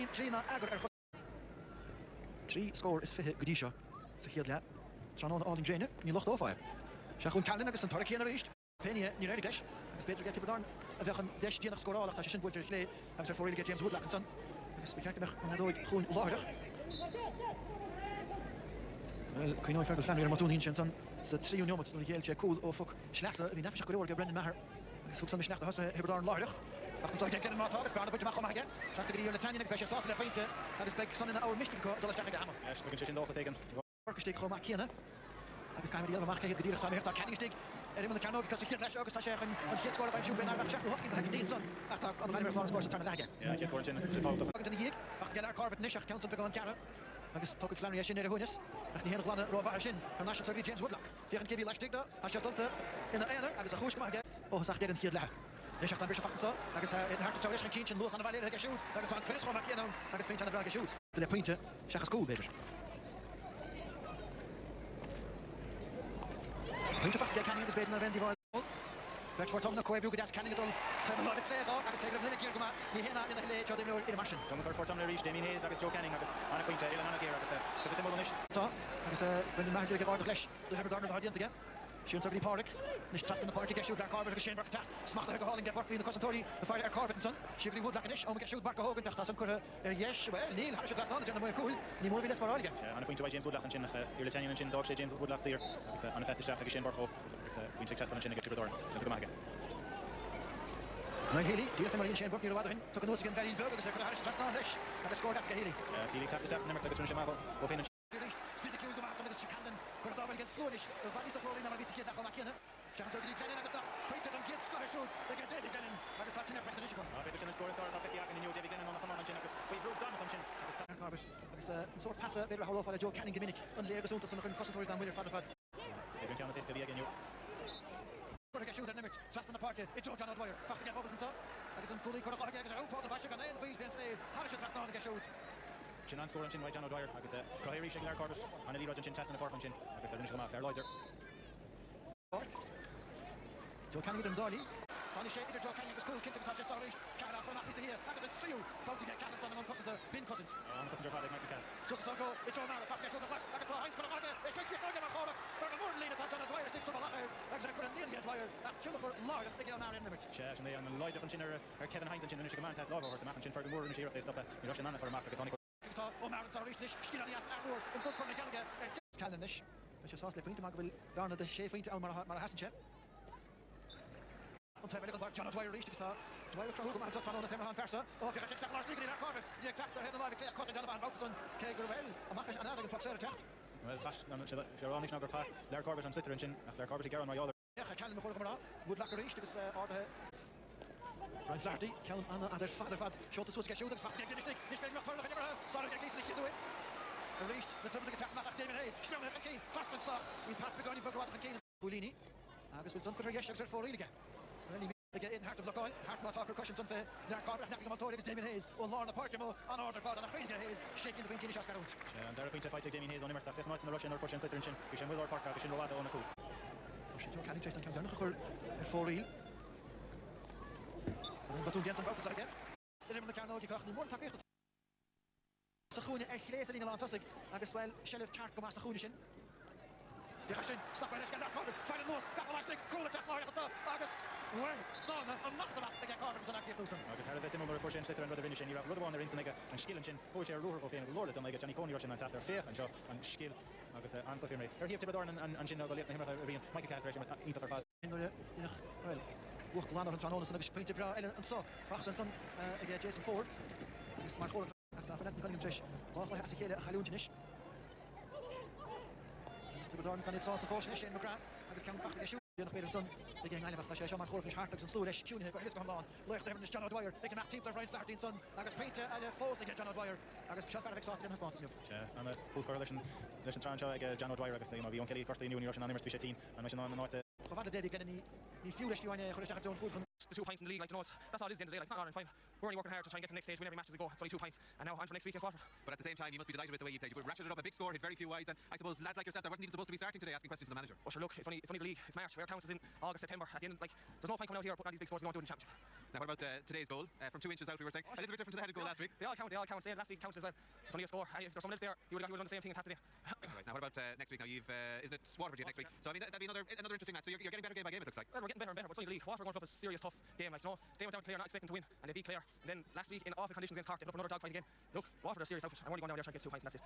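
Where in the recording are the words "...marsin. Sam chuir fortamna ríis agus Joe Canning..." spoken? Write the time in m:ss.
1:14.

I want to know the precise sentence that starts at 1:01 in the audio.
Tá le pointinte seachas cúil béidir.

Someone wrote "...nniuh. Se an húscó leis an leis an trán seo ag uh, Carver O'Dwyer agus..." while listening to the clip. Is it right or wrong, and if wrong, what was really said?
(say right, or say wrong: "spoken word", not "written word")
wrong: "John", not "Carver".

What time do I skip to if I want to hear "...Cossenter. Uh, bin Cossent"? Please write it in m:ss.
2:29.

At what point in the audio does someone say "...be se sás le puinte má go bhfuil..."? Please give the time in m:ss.
2:50.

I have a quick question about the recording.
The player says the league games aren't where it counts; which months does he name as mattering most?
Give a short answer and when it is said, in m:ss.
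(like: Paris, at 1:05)
August, September, at 4:53.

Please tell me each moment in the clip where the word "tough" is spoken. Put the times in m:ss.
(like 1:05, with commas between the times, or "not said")
5:09.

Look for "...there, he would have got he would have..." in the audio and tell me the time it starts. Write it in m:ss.
5:01.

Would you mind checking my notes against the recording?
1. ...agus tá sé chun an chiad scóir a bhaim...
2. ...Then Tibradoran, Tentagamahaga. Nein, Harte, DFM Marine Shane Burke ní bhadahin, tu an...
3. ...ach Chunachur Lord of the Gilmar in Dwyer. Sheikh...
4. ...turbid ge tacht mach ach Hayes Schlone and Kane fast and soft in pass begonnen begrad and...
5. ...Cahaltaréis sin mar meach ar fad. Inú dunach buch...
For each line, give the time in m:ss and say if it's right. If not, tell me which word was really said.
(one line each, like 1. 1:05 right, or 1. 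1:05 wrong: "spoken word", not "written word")
1. 0:38 right
2. 1:38 wrong: "Healy", not "Harte"
3. 2:38 wrong: "Limert", not "Dwyer"
4. 3:17 right
5. 4:06 wrong: "ítach", not "meach".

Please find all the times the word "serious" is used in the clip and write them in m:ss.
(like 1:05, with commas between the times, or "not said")
5:09, 5:15.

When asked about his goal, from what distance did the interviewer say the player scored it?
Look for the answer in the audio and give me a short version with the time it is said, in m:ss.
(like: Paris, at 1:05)
2 inches, at 4:57.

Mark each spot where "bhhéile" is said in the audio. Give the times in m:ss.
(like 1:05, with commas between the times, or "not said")
0:58.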